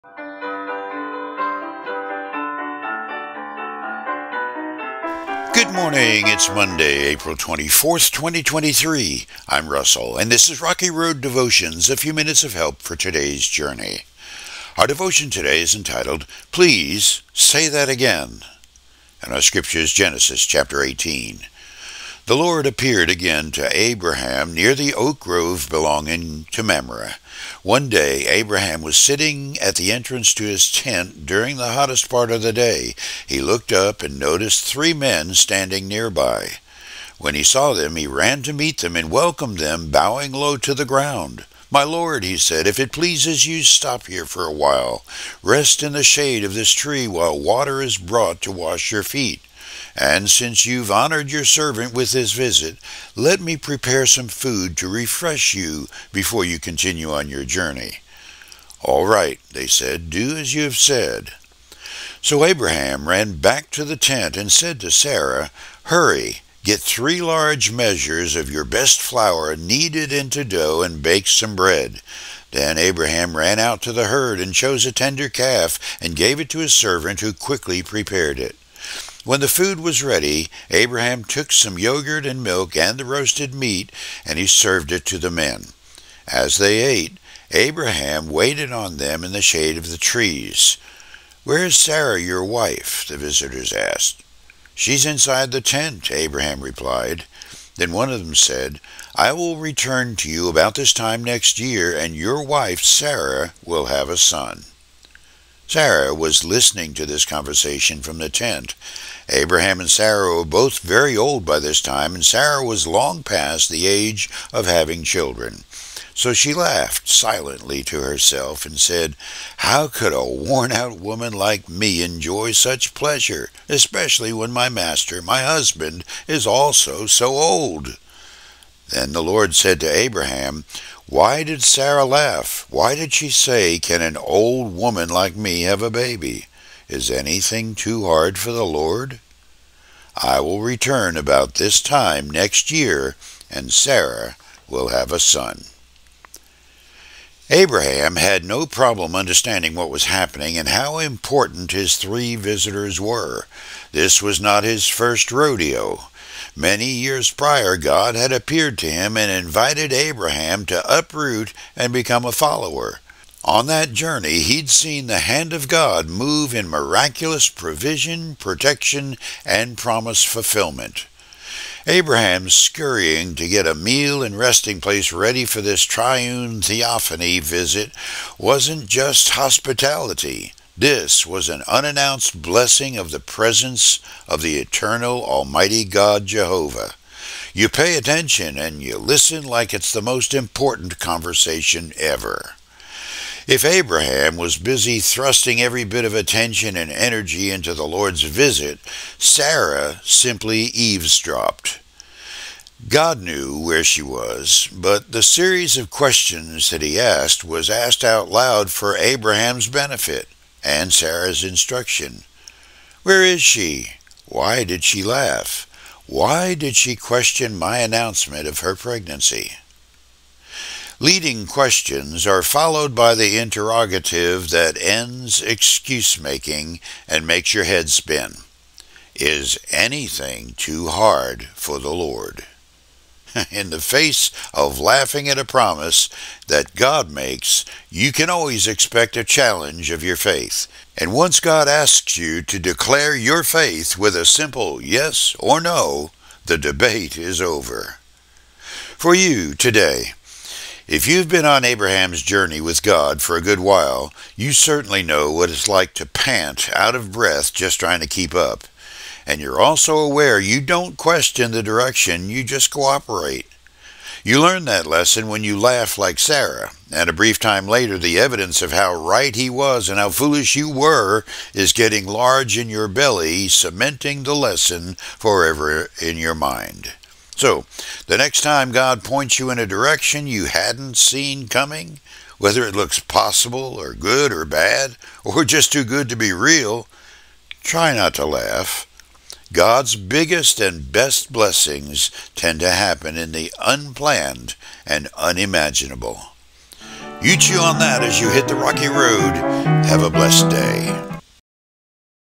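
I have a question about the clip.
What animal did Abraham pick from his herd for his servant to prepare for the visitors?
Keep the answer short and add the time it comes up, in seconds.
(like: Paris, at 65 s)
A tender calf, at 74 s.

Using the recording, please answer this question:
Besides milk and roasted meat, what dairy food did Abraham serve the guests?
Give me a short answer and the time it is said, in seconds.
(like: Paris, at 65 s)
Yogurt, at 81 s.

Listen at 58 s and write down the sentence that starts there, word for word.
All right, they said, do as you have said.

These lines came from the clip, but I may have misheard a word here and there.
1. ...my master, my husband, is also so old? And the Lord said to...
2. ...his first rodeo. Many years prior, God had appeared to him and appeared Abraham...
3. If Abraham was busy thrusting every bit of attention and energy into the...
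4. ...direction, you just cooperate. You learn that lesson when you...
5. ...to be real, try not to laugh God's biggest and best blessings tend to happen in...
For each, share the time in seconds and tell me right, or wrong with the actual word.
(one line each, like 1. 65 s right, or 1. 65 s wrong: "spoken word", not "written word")
1. 124 s right
2. 154 s wrong: "invited", not "appeared"
3. 193 s right
4. 261 s right
5. 286 s right.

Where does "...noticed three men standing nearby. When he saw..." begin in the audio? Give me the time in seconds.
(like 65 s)
34 s.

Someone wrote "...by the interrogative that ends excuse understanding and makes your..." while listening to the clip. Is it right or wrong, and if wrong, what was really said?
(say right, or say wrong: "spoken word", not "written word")
wrong: "making", not "understanding".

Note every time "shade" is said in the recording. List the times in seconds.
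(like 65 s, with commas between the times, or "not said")
46 s, 89 s.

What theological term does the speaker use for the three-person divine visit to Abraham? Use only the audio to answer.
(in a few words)
Triune theophany.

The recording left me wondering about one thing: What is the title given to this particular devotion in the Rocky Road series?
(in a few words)
Please Say That Again.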